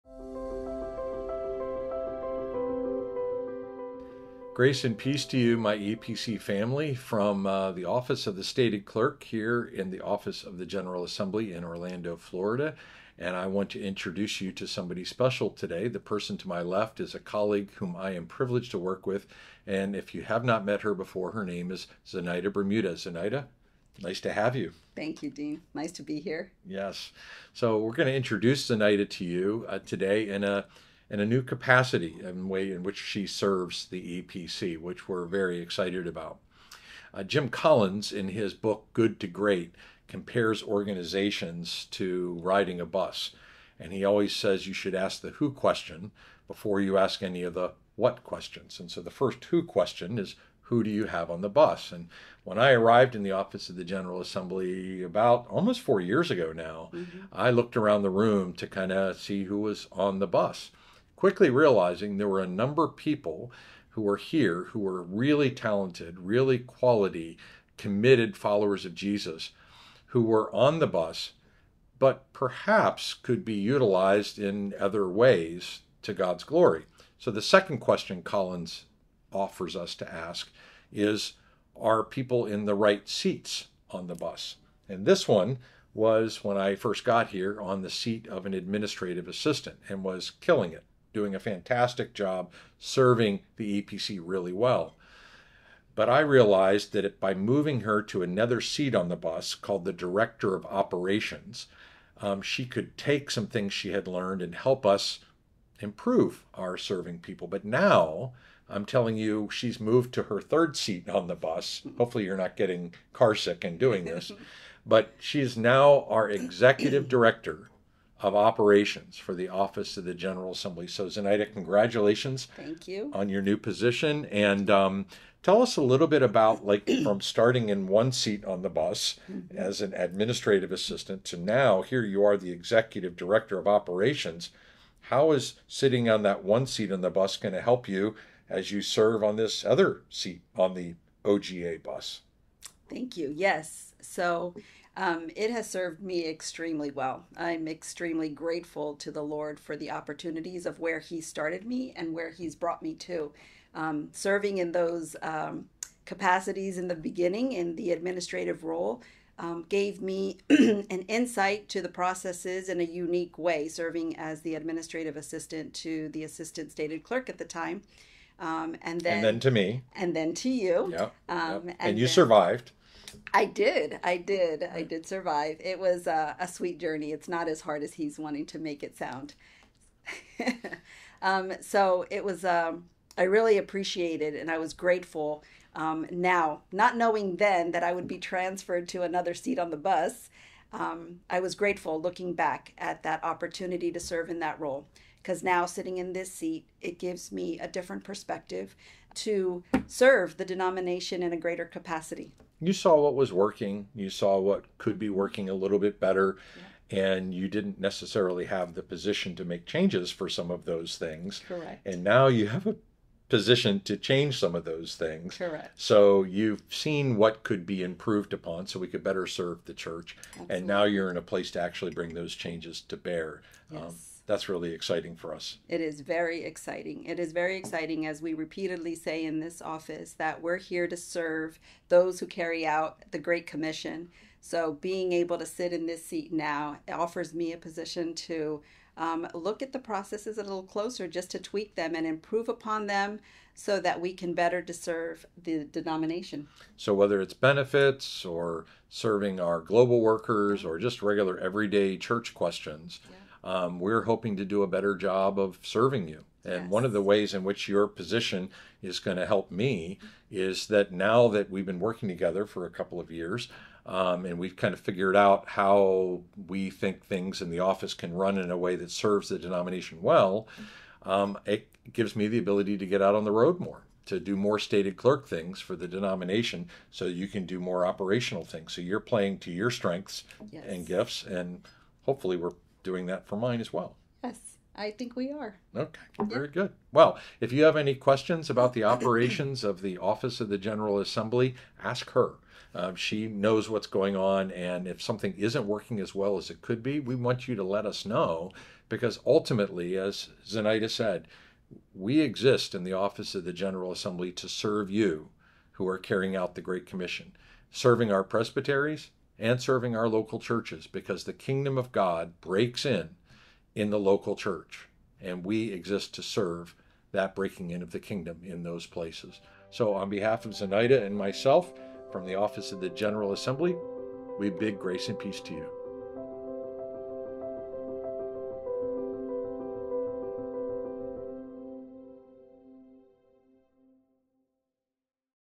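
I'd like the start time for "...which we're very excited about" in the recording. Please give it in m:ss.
0:34.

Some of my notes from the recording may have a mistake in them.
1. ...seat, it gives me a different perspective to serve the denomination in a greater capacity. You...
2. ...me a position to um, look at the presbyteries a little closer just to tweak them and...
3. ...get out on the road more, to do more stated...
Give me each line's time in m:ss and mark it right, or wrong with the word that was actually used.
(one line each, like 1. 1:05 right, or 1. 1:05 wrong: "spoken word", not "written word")
1. 3:16 right
2. 3:57 wrong: "processes", not "presbyteries"
3. 4:32 right.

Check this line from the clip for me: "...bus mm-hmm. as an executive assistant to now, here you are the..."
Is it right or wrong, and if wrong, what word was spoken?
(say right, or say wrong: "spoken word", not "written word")
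wrong: "administrative", not "executive".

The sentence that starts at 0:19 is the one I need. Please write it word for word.
And if you have not met her before, her name is Zenaida Bermudez.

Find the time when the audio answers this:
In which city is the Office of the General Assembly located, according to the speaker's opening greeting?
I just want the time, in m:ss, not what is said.
0:11.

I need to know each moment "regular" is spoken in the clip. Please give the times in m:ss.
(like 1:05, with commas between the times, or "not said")
4:11.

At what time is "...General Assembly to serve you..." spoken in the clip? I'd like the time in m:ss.
5:03.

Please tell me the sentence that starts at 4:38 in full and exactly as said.
So you're playing to your strengths yes.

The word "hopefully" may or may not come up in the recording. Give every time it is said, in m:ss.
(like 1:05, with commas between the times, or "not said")
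1:51, 4:42.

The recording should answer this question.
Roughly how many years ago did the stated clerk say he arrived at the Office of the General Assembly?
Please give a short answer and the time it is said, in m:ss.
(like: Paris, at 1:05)
almost 4 years, at 0:55.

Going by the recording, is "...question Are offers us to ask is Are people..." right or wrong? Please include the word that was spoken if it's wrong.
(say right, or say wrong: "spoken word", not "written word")
wrong: "Collins", not "Are".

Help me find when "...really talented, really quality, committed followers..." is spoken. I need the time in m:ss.
1:05.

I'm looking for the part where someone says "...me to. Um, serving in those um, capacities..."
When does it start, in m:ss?
2:32.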